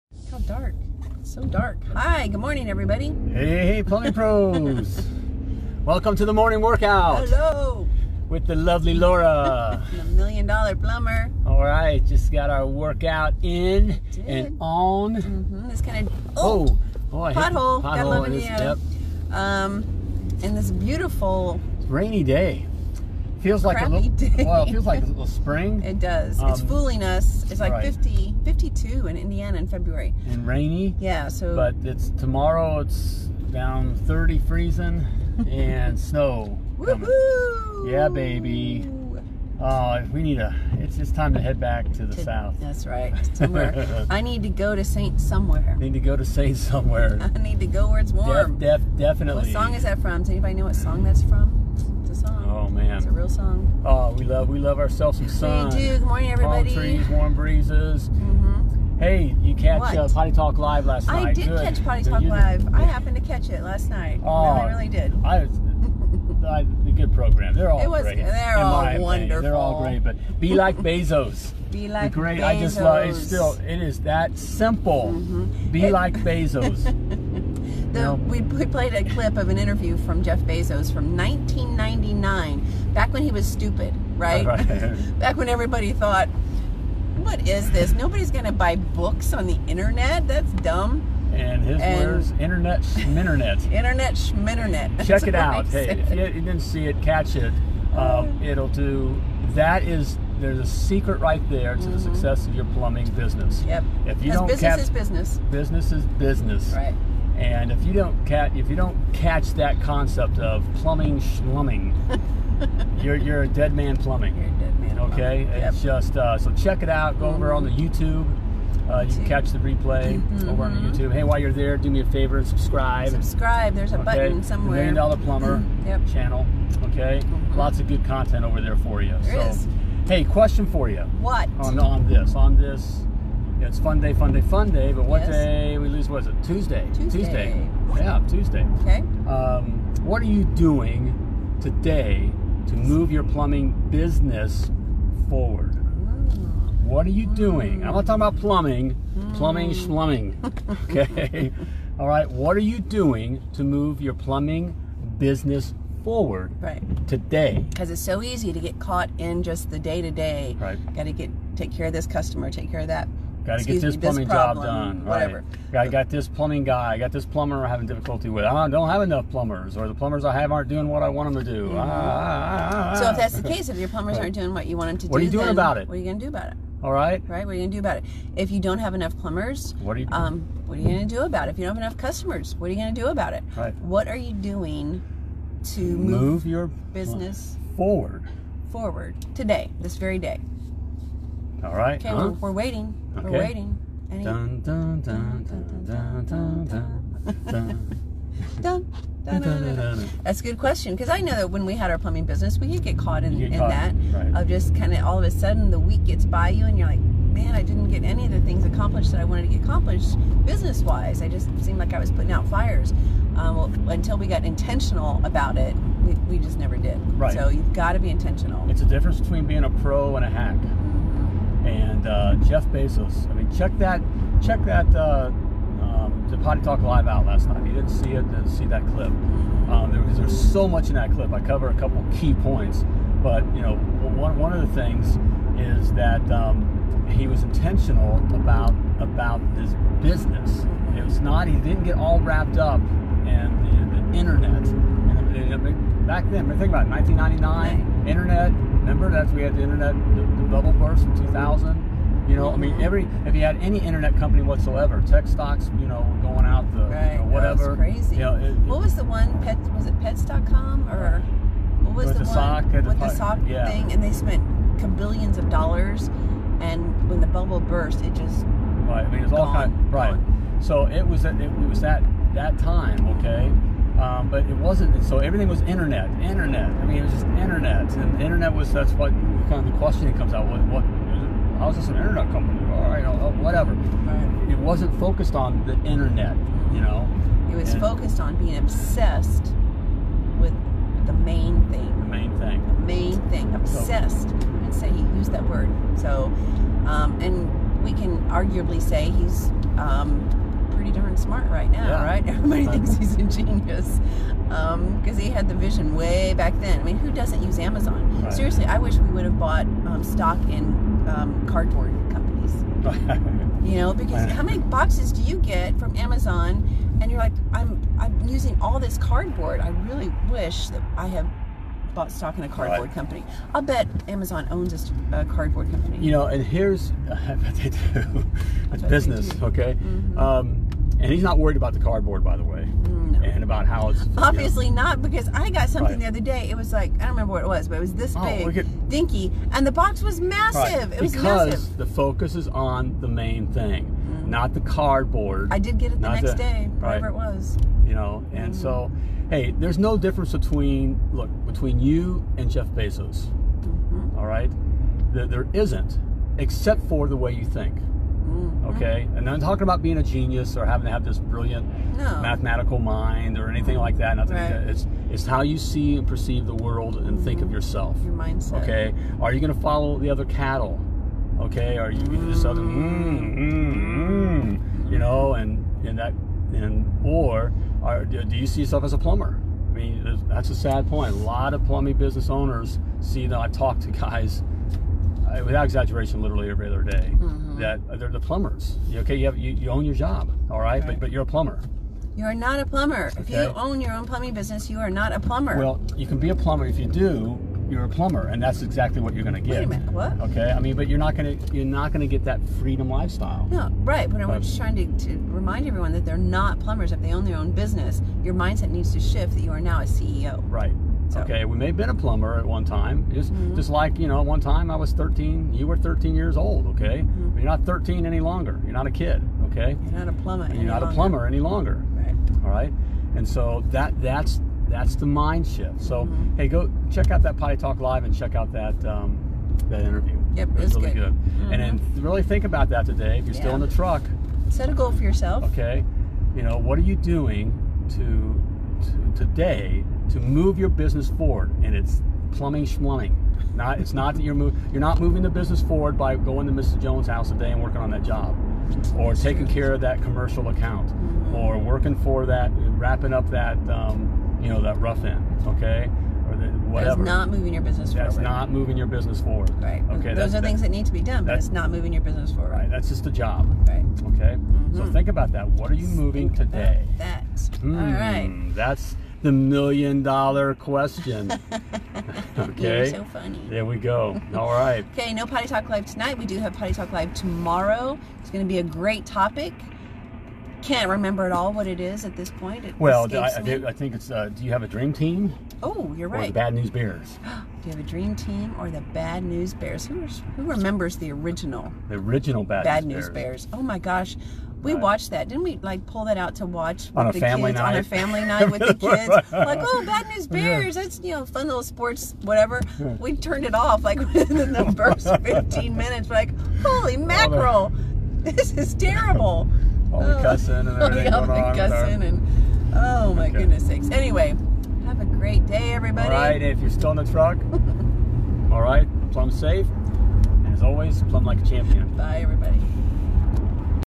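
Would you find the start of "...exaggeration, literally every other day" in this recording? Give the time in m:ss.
6:25.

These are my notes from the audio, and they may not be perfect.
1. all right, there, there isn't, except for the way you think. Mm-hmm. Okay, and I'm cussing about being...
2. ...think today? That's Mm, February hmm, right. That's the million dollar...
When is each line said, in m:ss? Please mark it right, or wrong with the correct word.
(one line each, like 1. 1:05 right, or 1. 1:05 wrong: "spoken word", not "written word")
1. 5:54 wrong: "talking", not "cussing"
2. 7:46 wrong: "All", not "February".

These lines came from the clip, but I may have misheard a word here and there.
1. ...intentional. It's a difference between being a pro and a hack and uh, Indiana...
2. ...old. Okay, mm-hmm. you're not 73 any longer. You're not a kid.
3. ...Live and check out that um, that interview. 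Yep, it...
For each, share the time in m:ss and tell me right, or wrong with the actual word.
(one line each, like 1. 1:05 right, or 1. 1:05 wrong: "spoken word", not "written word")
1. 3:38 wrong: "Jeff", not "Indiana"
2. 6:56 wrong: "13", not "73"
3. 7:07 right.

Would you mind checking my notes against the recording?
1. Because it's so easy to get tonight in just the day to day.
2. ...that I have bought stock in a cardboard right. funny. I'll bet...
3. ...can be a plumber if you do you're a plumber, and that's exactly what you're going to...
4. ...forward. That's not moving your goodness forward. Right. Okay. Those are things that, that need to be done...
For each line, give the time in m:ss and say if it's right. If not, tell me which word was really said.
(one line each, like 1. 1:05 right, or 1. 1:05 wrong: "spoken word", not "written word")
1. 2:37 wrong: "caught", not "tonight"
2. 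5:20 wrong: "company", not "funny"
3. 6:36 right
4. 7:37 wrong: "business", not "goodness".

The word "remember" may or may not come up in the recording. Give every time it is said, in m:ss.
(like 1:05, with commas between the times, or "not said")
4:08, 5:37, 8:00, 8:10.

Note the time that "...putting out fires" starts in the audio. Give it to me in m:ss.
3:32.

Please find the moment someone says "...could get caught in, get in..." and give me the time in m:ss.
3:22.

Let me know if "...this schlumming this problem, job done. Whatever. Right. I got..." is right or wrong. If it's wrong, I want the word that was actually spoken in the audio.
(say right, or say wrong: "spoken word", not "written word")
wrong: "plumbing", not "schlumming".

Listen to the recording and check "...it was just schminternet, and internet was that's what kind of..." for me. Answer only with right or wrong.
wrong.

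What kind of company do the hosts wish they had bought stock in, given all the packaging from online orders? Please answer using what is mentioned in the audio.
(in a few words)
cardboard companies.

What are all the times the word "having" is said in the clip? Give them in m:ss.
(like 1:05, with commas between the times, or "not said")
2:47, 6:00.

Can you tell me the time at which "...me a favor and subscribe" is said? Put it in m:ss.
2:01.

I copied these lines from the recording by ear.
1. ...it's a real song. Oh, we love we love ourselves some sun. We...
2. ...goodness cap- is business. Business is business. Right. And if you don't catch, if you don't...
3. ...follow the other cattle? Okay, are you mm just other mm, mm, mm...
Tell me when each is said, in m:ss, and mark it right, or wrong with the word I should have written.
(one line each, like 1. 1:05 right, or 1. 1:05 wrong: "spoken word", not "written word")
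1. 0:52 right
2. 1:44 wrong: "business", not "goodness"
3. 6:09 right.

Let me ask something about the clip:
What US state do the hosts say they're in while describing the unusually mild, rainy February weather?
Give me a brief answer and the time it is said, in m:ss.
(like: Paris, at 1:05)
Indiana, at 0:29.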